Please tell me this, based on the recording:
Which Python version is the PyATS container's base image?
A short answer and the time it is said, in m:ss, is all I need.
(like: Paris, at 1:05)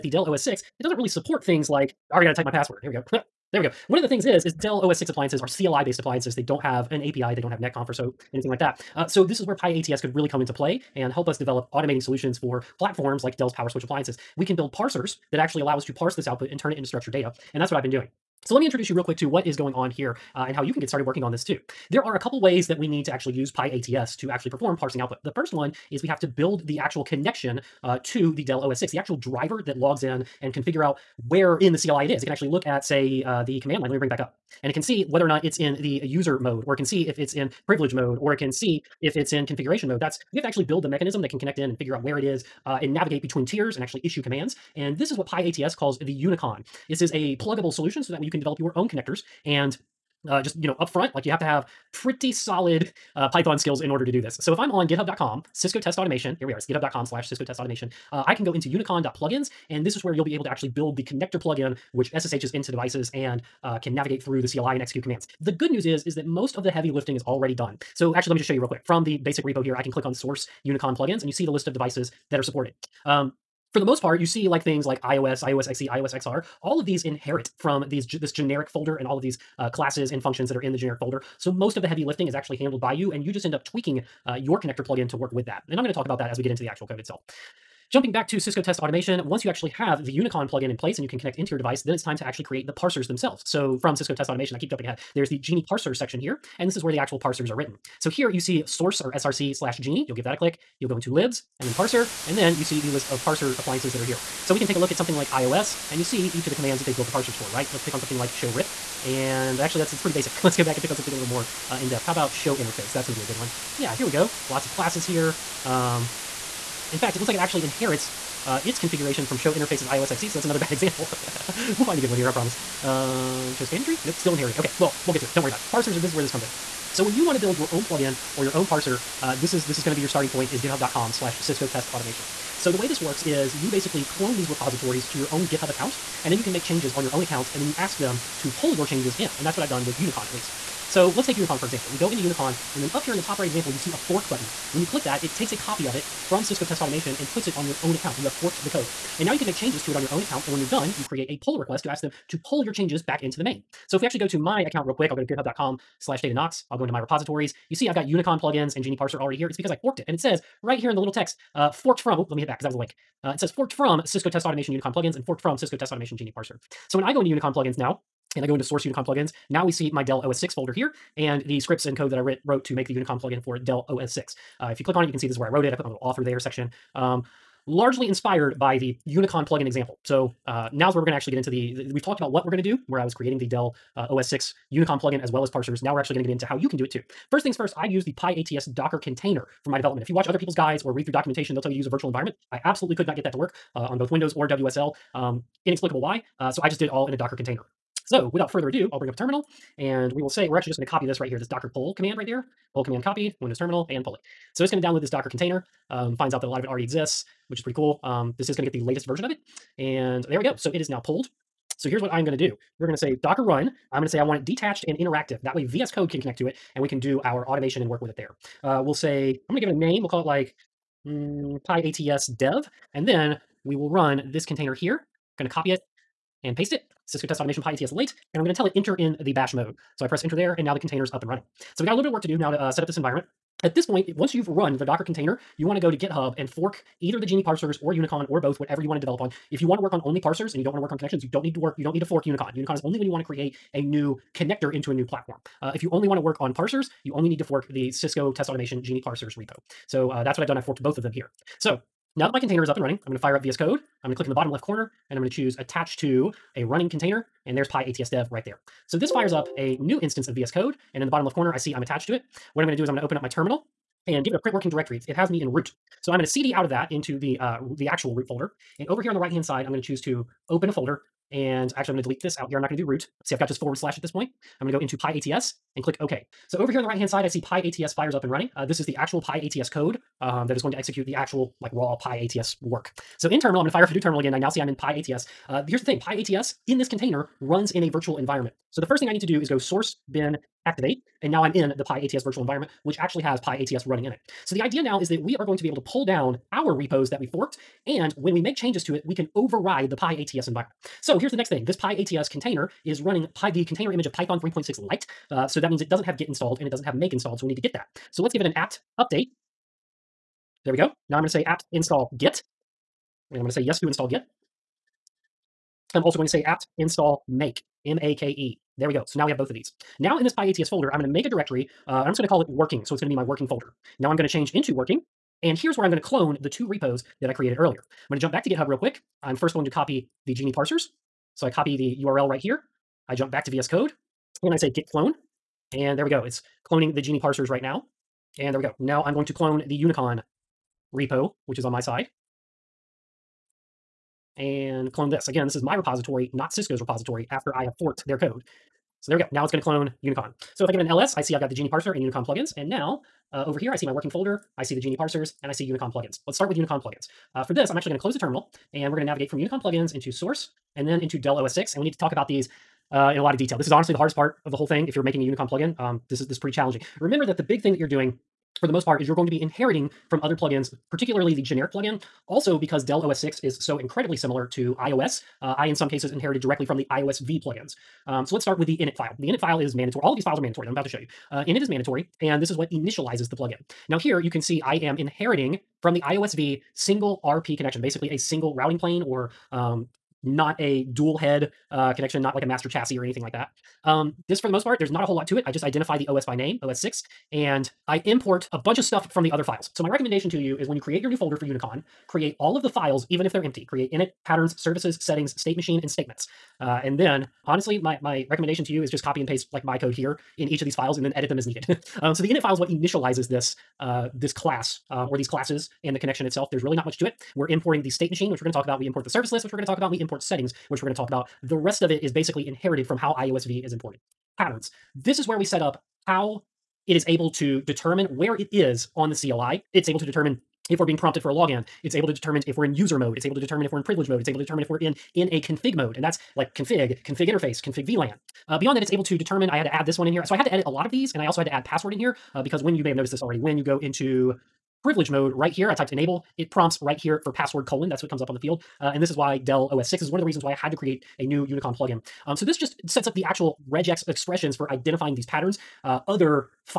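3.6, at 5:04.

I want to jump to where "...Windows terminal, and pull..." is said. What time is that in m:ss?
3:23.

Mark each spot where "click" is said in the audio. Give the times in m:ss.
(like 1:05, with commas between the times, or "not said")
1:09, 1:40, 2:24, 2:54, 4:14, 4:35.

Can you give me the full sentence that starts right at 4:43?
So in terminal, I'm going to fire up a new terminal again.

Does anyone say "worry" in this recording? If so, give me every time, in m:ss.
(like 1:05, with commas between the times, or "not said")
2:05.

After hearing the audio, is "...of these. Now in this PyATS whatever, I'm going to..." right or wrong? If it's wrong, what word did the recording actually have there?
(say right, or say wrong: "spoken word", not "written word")
wrong: "folder", not "whatever".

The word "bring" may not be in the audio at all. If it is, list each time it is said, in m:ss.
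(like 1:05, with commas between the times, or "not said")
0:33, 3:18.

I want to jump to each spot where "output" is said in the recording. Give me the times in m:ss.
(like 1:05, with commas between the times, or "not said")
0:16, 0:24.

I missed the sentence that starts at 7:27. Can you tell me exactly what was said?
That's what comes up on the field.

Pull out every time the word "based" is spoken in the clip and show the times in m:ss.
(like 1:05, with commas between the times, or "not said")
0:05.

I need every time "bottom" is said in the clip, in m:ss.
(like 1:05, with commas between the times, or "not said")
4:14, 4:21.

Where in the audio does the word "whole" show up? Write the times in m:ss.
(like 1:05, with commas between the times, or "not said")
6:04, 6:35.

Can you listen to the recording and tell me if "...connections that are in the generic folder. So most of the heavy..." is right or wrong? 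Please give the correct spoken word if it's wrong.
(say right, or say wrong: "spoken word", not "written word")
wrong: "functions", not "connections".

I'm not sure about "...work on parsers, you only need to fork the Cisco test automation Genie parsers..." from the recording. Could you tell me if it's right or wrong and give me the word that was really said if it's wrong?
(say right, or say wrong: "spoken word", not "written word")
right.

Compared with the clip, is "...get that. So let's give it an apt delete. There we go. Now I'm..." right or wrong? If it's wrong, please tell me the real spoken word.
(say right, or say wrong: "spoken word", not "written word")
wrong: "update", not "delete".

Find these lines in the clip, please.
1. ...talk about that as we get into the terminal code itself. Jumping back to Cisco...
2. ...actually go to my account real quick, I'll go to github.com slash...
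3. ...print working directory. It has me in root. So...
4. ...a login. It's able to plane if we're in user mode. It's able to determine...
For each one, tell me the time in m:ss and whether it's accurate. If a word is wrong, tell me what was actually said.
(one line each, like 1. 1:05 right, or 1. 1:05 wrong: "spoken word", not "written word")
1. 1:25 wrong: "actual", not "terminal"
2. 2:34 right
3. 4:24 right
4. 7:11 wrong: "determine", not "plane".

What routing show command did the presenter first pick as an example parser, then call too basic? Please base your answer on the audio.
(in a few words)
show rip.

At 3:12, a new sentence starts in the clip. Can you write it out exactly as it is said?
I absolutely could not get that to work uh, on both Windows or WSL.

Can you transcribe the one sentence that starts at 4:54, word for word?
So the idea now is that we are going to be able to pull down our repos that we forked.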